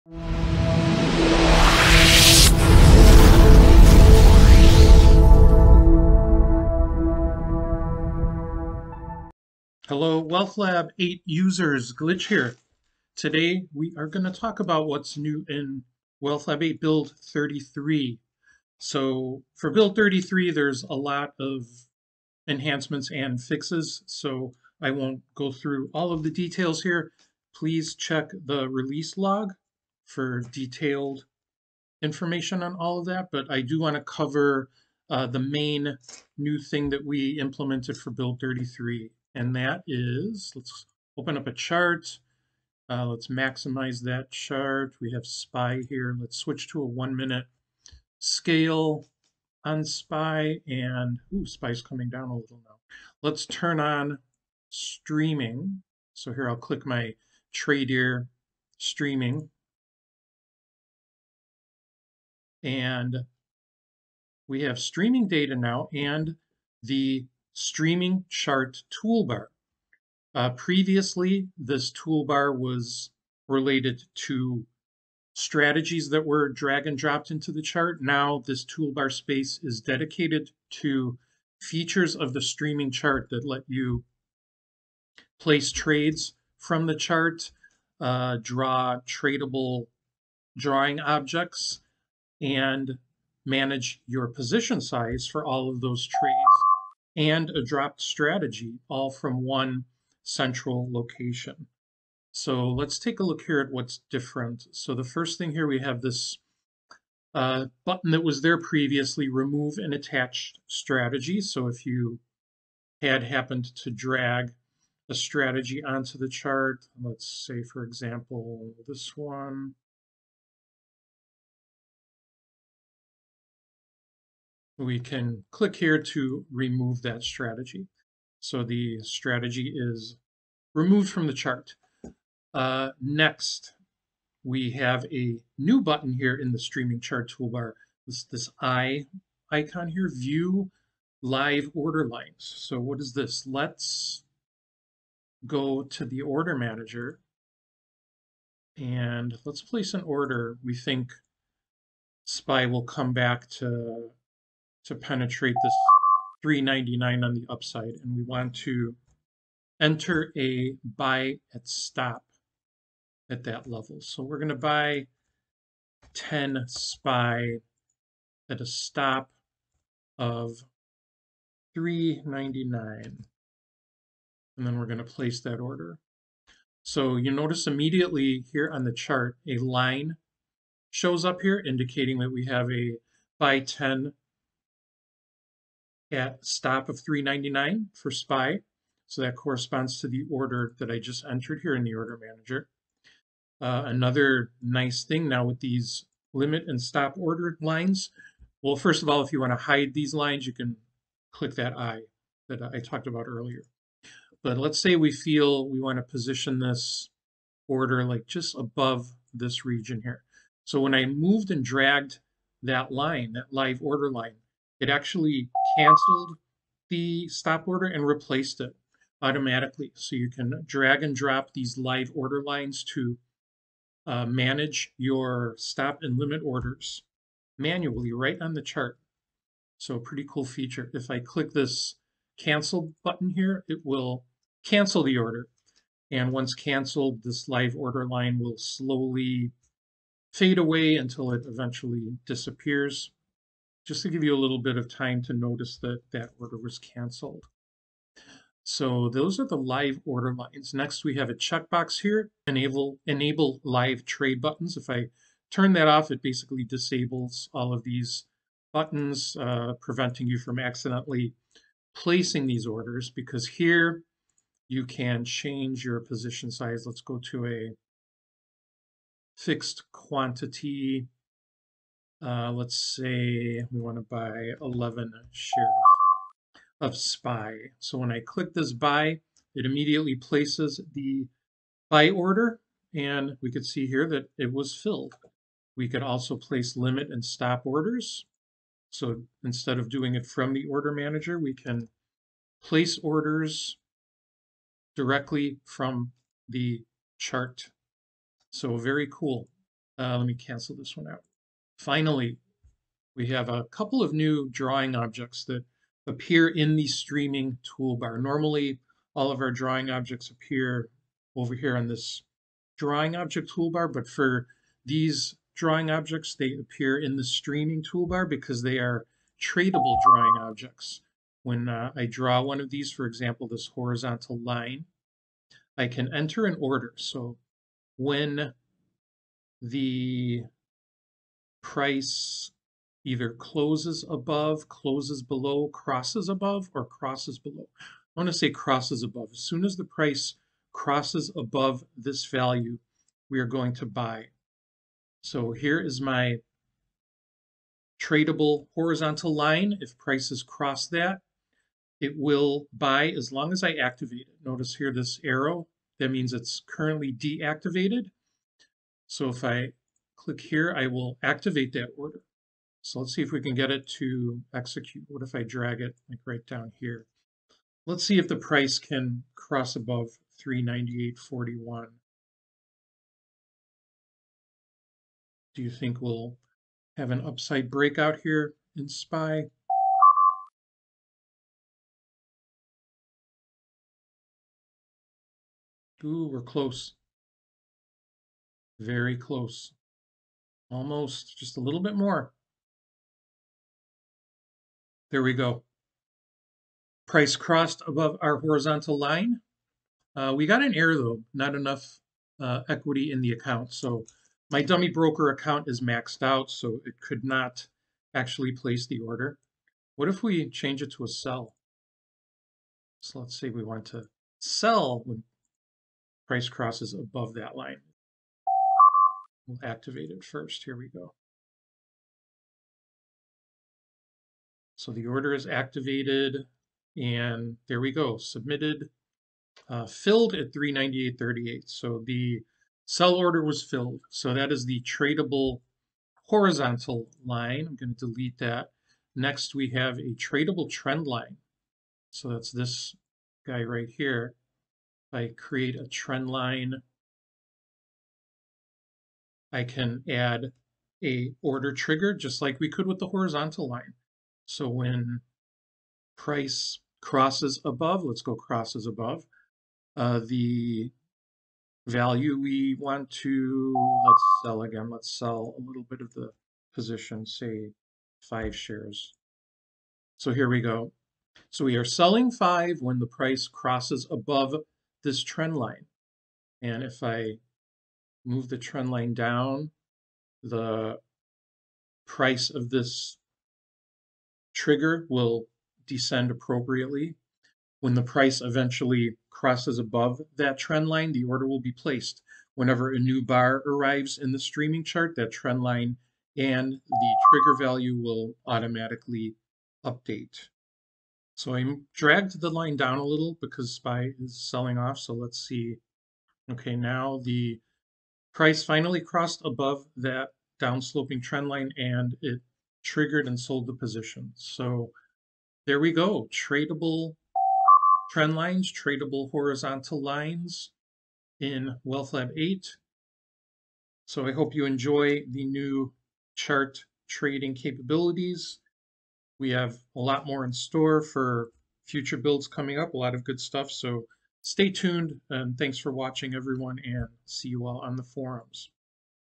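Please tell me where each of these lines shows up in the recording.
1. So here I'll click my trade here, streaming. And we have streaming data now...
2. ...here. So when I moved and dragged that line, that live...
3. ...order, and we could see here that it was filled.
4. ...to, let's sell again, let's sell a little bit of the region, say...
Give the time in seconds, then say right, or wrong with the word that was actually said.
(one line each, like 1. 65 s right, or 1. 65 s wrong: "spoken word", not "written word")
1. 56 s right
2. 210 s right
3. 282 s right
4. 463 s wrong: "position", not "region".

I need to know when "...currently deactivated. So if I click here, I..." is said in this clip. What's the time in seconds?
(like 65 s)
356 s.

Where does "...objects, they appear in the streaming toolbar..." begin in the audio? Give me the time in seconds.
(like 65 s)
315 s.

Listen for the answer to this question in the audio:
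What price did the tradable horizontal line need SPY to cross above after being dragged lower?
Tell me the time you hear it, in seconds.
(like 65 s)
370 s.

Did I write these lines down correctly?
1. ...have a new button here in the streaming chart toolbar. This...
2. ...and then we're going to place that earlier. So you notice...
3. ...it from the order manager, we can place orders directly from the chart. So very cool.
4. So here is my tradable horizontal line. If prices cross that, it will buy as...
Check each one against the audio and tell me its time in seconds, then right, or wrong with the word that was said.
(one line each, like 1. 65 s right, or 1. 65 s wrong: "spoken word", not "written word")
1. 134 s right
2. 174 s wrong: "order", not "earlier"
3. 290 s right
4. 345 s right.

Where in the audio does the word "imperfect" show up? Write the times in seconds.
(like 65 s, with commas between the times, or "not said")
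not said.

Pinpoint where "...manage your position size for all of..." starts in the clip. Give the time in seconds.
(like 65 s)
93 s.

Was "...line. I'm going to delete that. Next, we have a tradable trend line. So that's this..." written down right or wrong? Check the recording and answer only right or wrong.
right.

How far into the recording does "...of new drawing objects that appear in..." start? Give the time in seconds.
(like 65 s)
304 s.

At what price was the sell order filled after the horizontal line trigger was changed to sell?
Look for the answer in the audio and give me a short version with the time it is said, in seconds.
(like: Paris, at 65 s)
398.38, at 430 s.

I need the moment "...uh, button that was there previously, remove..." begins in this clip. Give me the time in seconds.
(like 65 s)
107 s.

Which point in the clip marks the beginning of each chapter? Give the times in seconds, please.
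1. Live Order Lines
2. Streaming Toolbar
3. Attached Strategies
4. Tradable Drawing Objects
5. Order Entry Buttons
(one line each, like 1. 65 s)
1. 132 s
2. 39 s
3. 104 s
4. 303 s
5. 247 s.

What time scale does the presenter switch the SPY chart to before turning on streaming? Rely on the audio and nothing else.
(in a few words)
One minute.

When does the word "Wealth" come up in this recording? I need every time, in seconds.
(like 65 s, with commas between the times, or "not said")
10 s, 16 s, 521 s.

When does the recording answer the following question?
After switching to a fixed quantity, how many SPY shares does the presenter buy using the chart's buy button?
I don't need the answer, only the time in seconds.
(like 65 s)
274 s.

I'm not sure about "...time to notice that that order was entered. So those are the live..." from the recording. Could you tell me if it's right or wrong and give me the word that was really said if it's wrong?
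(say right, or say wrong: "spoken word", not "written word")
wrong: "canceled", not "entered".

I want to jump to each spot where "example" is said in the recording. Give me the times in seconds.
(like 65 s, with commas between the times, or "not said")
117 s, 323 s.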